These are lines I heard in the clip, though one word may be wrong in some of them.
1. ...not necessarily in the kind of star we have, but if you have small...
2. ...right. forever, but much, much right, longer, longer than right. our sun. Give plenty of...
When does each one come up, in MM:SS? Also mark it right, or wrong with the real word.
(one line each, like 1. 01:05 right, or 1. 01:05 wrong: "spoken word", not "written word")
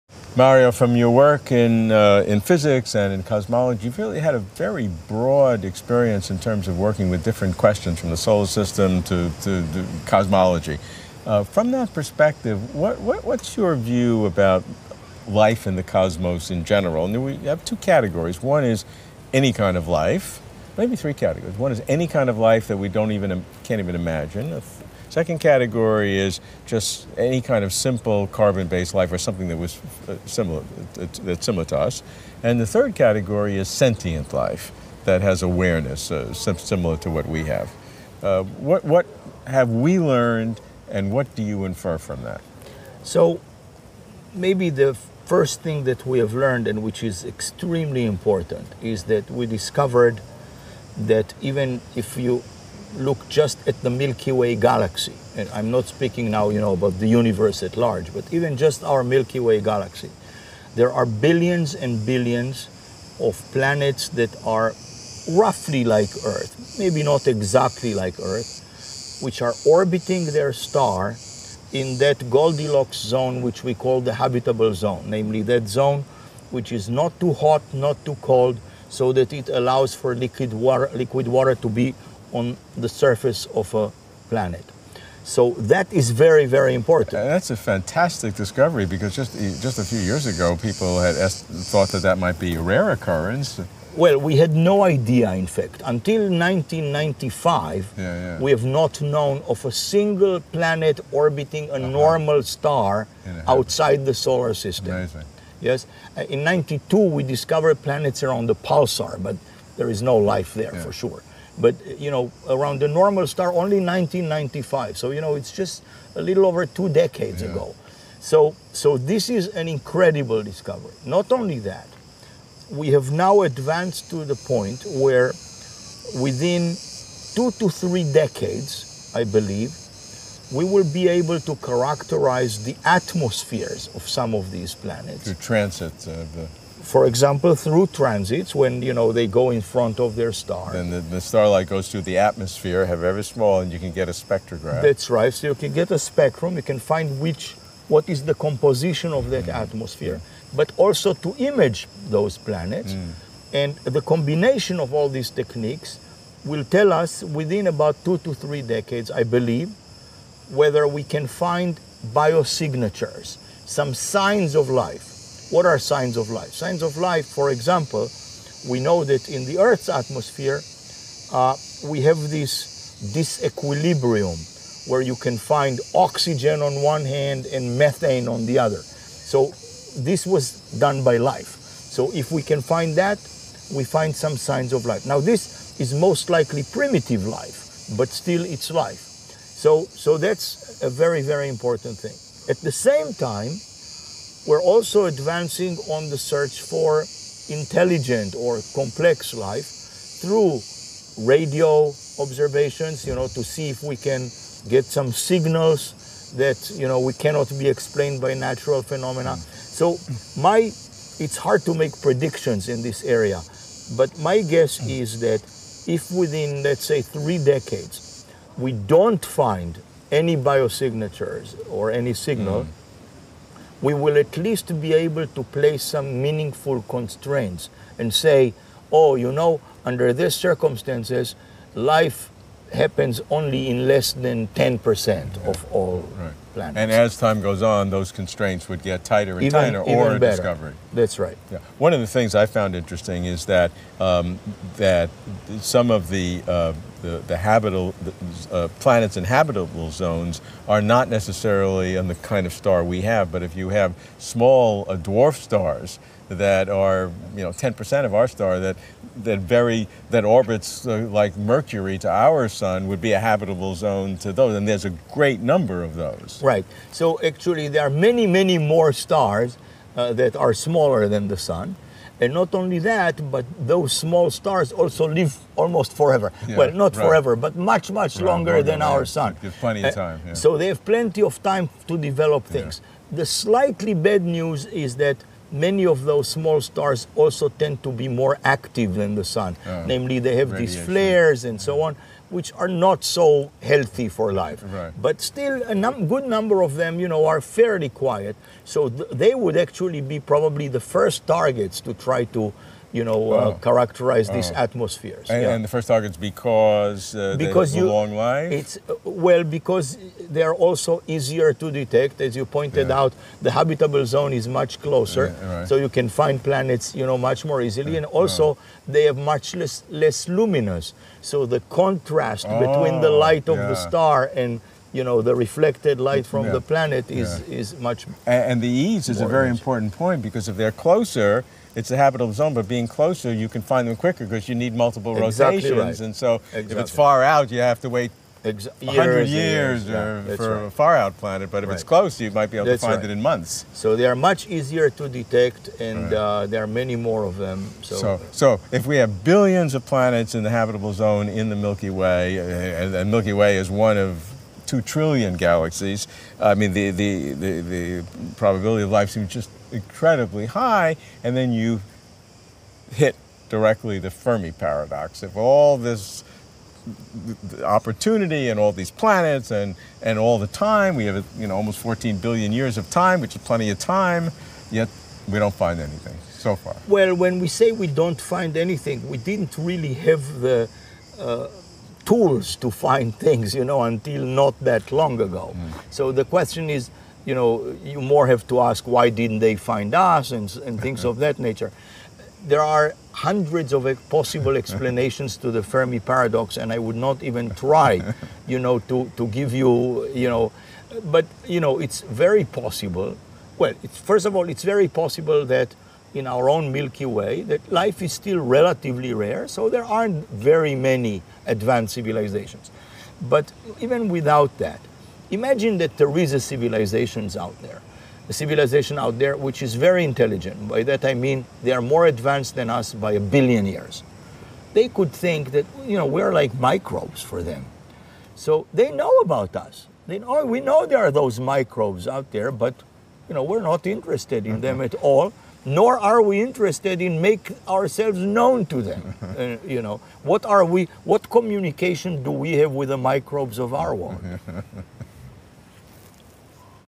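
1. 04:10 right
2. 04:36 right.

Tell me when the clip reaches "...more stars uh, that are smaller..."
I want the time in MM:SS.
04:28.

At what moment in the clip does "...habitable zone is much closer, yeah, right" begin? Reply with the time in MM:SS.
05:13.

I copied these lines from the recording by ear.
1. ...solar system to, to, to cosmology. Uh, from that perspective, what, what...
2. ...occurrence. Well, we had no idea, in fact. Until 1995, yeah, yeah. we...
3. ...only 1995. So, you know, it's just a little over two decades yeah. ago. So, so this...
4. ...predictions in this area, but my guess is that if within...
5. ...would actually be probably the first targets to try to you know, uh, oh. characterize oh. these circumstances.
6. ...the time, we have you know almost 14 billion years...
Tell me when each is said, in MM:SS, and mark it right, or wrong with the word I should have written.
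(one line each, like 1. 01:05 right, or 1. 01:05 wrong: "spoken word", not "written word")
1. 00:08 right
2. 01:32 right
3. 01:53 right
4. 03:32 right
5. 04:59 wrong: "atmospheres", not "circumstances"
6. 06:10 right.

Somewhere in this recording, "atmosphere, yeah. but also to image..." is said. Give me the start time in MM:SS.
02:29.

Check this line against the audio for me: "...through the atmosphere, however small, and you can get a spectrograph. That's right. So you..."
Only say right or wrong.
right.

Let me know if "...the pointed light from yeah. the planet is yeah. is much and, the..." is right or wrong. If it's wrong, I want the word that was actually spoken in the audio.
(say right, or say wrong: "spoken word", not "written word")
wrong: "reflected", not "pointed".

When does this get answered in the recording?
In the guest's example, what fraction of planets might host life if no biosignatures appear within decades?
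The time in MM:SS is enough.
03:53.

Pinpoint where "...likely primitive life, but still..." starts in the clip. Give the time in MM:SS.
03:06.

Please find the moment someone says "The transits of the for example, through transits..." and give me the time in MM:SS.
02:15.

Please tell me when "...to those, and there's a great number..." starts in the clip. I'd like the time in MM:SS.
04:24.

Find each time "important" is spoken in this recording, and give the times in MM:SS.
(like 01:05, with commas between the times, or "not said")
00:48, 01:26, 03:11, 05:29.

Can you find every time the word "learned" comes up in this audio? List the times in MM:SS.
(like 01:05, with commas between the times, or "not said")
00:39, 00:46.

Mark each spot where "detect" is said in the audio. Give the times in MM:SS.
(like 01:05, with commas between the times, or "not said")
05:11, 05:45.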